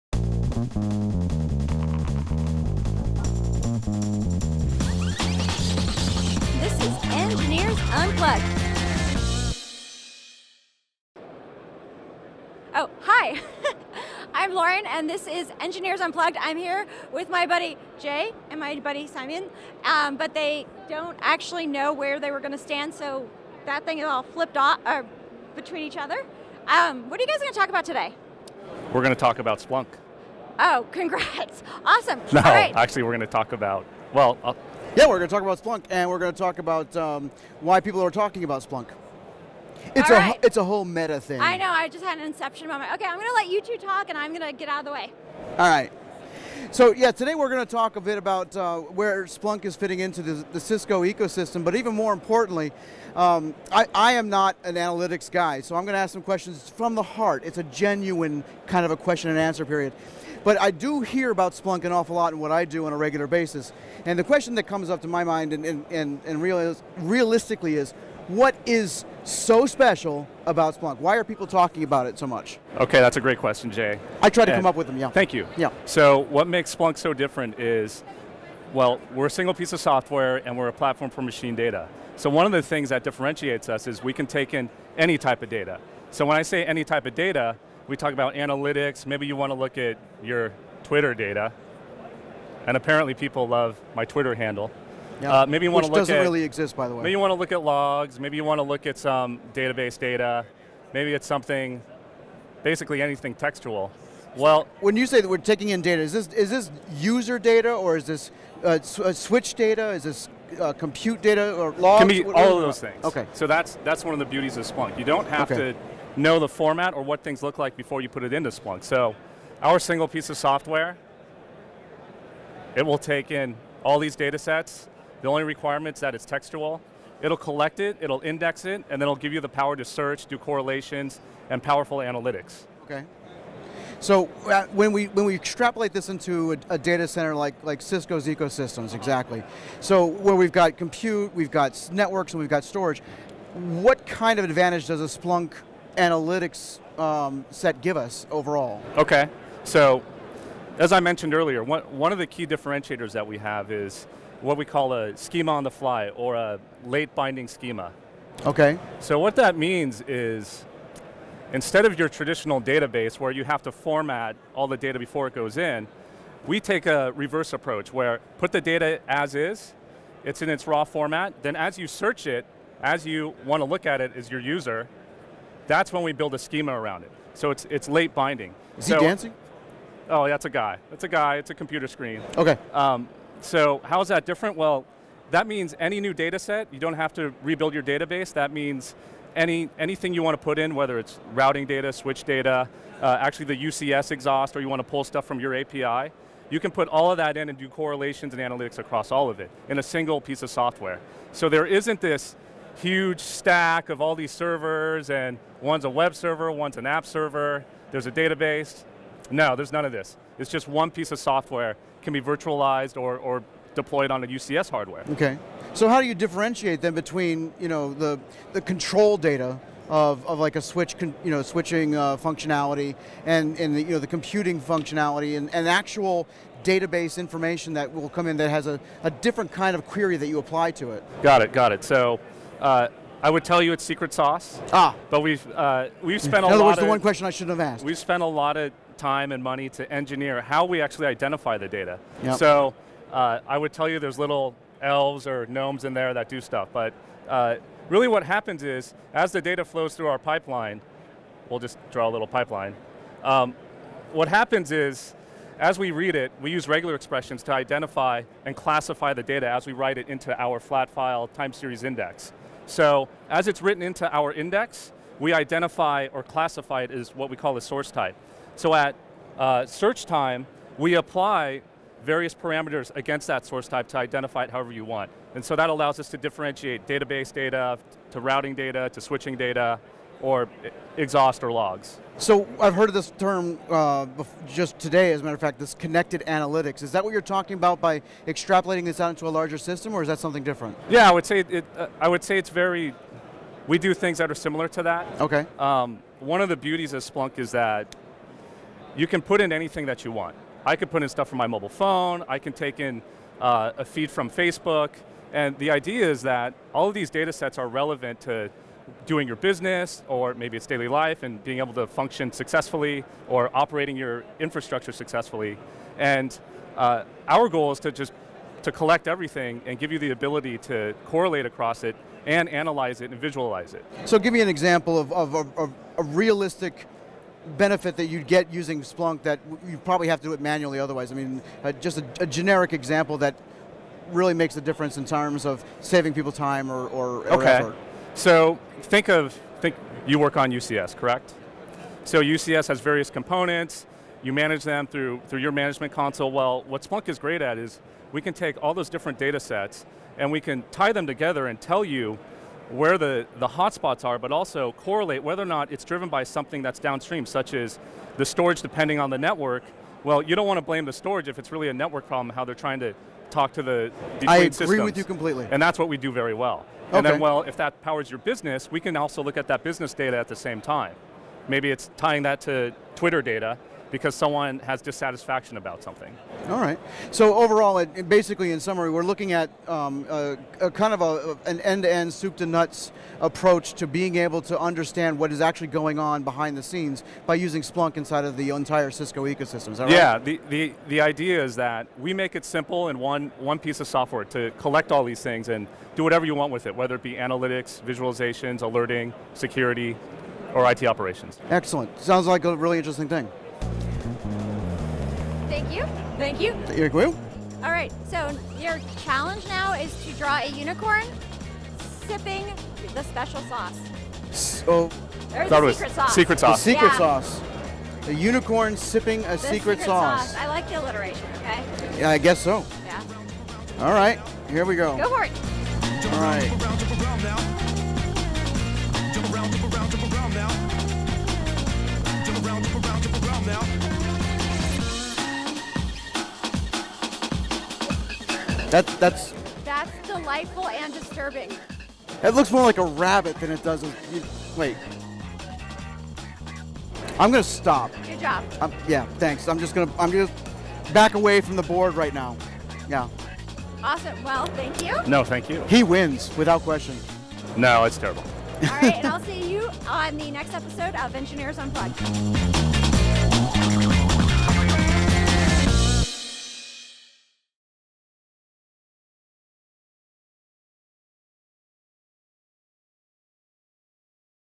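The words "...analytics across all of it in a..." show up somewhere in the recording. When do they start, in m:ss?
3:18.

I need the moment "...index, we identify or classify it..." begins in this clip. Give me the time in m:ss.
4:24.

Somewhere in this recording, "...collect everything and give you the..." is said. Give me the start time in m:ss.
5:18.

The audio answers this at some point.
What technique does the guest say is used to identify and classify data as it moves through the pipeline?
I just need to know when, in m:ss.
4:16.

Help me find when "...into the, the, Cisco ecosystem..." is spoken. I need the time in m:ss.
0:50.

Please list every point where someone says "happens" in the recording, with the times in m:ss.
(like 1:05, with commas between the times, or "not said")
4:08, 4:14.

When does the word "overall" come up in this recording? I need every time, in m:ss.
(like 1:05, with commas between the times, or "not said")
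2:28, 6:17.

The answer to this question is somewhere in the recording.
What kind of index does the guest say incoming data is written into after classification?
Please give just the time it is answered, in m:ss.
4:20.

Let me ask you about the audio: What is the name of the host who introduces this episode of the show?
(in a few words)
Lauren.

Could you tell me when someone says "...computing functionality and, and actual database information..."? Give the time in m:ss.
3:44.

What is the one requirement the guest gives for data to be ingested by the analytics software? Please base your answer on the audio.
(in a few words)
It's textual.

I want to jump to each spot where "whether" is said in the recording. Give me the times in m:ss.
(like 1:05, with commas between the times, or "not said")
3:10, 5:55, 6:36.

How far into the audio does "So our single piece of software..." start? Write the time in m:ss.
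1:58.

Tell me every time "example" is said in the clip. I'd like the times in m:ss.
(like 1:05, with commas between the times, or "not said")
5:24, 5:32.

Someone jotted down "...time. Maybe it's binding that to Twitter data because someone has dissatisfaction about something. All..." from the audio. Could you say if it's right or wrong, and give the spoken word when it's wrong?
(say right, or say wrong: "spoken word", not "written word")
wrong: "tying", not "binding".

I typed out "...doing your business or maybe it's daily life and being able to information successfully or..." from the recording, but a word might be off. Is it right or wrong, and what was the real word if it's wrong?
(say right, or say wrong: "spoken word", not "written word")
wrong: "function", not "information".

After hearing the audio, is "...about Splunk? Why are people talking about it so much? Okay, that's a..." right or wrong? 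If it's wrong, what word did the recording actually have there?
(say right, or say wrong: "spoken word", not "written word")
right.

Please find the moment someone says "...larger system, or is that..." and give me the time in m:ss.
4:49.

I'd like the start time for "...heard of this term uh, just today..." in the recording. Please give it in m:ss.
4:42.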